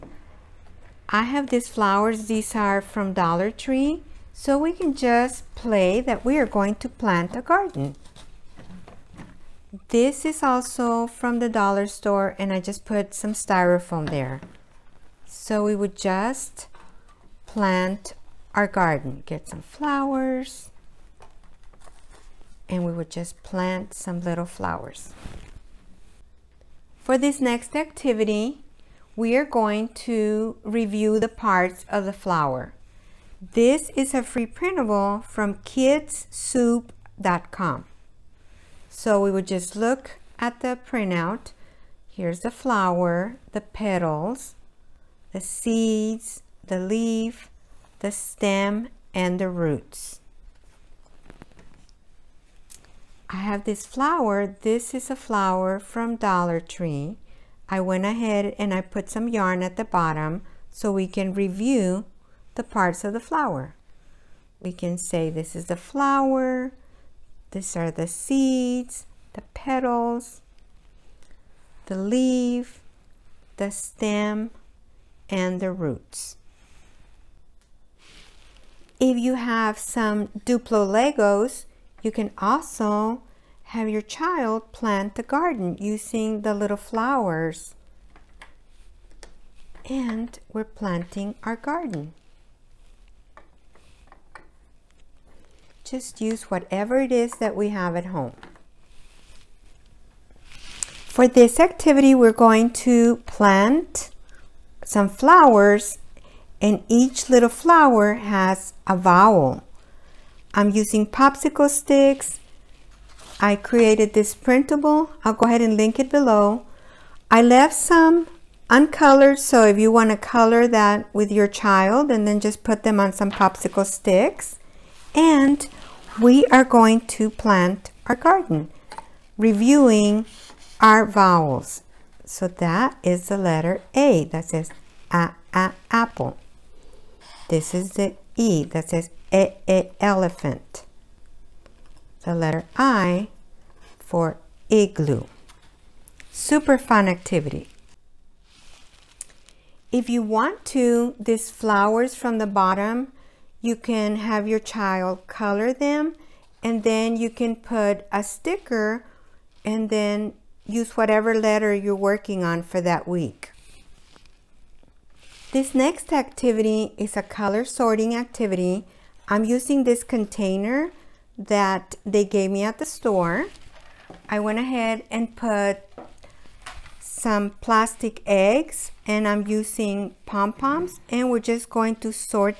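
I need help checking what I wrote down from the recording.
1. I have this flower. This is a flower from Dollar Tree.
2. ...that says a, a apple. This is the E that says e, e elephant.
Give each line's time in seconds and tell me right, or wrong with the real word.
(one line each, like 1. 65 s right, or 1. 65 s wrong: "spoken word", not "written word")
1. 53 s right
2. 134 s right.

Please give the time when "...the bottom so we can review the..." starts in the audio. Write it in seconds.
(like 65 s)
59 s.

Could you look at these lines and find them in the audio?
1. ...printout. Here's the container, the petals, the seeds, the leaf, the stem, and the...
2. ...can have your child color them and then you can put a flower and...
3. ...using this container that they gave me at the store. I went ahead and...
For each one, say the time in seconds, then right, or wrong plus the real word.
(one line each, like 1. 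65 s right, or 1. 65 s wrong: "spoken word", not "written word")
1. 40 s wrong: "flower", not "container"
2. 153 s wrong: "sticker", not "flower"
3. 169 s right.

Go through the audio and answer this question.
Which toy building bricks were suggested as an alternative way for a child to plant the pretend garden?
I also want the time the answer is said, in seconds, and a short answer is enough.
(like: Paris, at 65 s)
Duplo Legos, at 80 s.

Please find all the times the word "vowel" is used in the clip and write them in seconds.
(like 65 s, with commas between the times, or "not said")
108 s, 131 s.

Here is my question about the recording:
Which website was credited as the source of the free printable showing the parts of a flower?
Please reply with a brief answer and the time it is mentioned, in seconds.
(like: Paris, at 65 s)
kidssoup.com, at 35 s.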